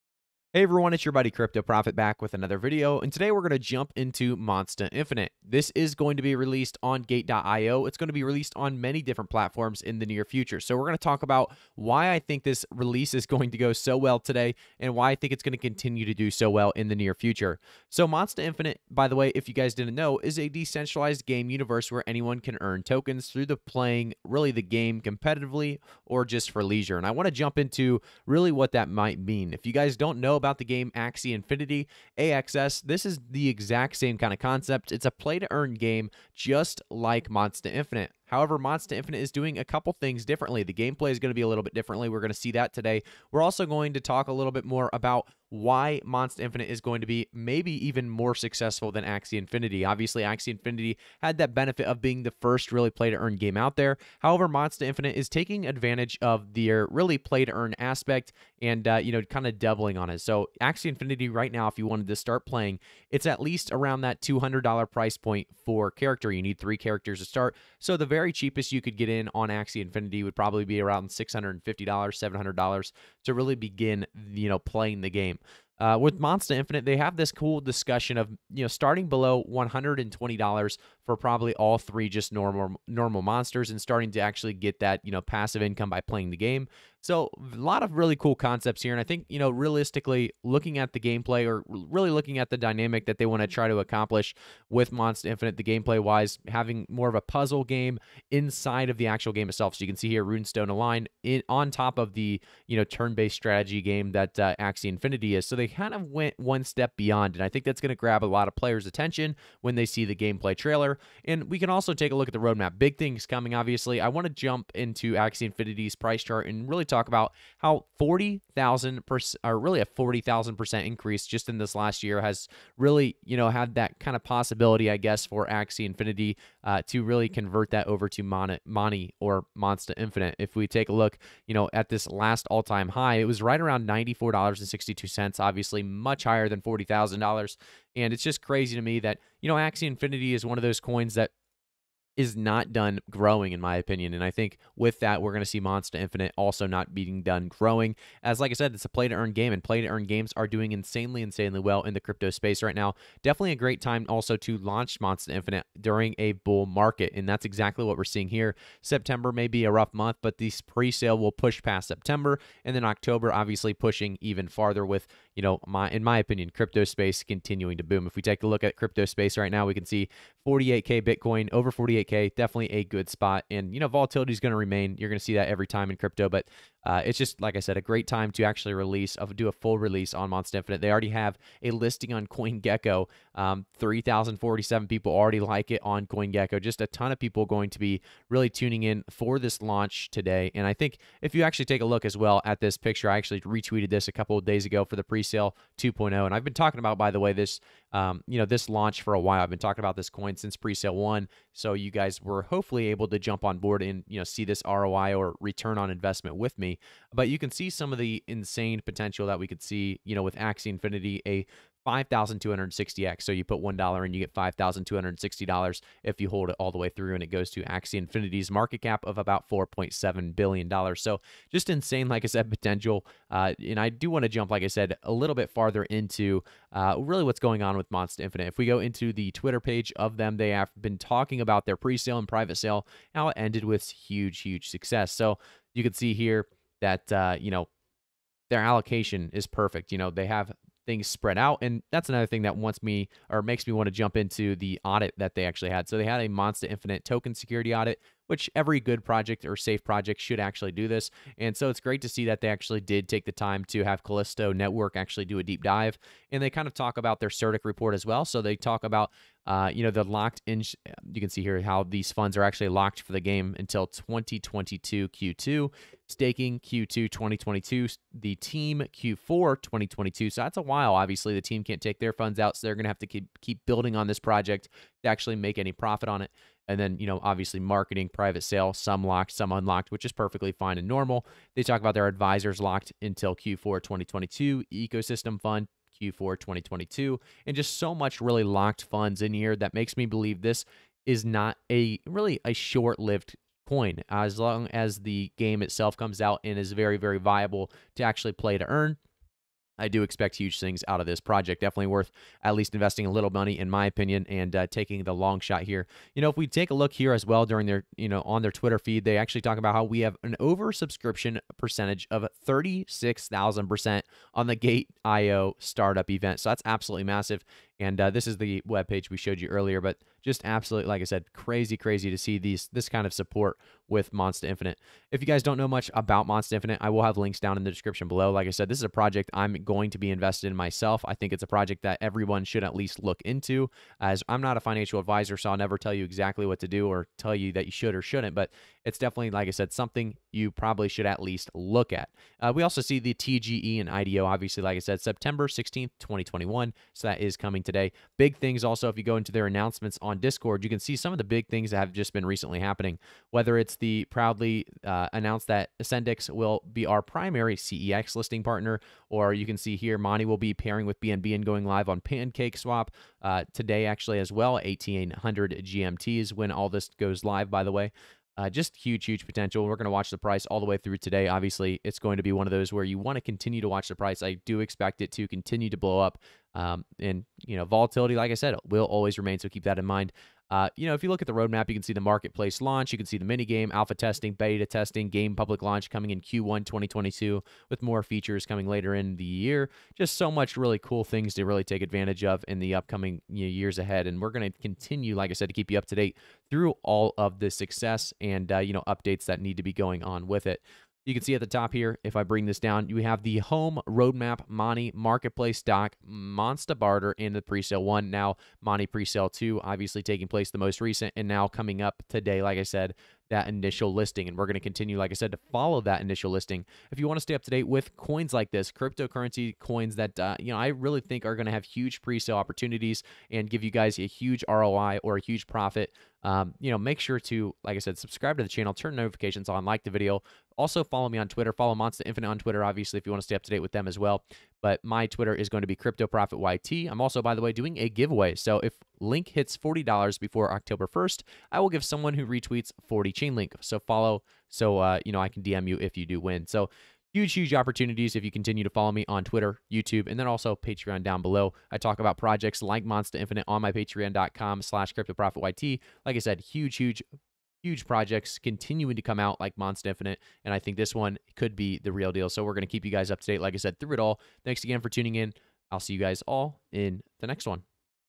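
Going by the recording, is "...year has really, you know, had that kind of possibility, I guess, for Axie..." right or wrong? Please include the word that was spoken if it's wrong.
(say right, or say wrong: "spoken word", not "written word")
right.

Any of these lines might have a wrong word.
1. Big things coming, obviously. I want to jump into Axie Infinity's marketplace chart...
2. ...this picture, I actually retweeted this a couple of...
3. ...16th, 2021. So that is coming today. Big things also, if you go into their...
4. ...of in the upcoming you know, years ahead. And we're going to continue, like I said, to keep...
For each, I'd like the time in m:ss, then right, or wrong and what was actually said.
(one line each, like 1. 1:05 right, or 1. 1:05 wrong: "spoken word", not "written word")
1. 1:52 wrong: "price", not "marketplace"
2. 3:12 right
3. 5:45 right
4. 6:32 right.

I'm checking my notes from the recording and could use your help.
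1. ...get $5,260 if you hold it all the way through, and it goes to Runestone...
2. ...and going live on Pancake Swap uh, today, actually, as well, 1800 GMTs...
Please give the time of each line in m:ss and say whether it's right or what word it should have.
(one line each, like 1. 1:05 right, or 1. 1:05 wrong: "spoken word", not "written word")
1. 3:34 wrong: "Axie", not "Runestone"
2. 6:01 right.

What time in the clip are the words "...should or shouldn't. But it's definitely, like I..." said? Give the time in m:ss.
5:37.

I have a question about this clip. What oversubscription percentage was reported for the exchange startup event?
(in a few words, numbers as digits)
36,000%.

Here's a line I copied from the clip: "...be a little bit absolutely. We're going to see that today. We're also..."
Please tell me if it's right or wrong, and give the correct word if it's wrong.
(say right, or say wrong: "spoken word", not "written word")
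wrong: "differently", not "absolutely".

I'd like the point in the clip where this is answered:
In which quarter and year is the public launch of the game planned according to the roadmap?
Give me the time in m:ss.
6:26.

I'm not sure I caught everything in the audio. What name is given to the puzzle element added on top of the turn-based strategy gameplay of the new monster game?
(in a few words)
Runestone Align.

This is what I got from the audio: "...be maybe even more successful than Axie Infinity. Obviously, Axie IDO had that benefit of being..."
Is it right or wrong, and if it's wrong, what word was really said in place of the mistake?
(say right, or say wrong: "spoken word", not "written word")
wrong: "Infinity", not "IDO".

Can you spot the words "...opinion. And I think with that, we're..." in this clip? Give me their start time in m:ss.
2:23.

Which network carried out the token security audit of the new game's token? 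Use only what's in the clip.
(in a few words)
Callisto Network.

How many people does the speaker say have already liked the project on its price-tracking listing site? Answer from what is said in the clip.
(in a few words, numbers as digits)
3,047.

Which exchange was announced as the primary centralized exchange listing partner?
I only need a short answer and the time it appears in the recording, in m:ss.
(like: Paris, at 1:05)
AscendEX, at 5:55.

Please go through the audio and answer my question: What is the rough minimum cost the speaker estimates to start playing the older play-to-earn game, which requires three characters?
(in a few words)
$650.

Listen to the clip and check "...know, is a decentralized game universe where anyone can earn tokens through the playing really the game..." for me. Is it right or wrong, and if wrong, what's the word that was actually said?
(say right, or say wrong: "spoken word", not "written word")
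right.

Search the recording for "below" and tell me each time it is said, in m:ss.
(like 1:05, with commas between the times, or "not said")
1:19, 5:28, 7:31.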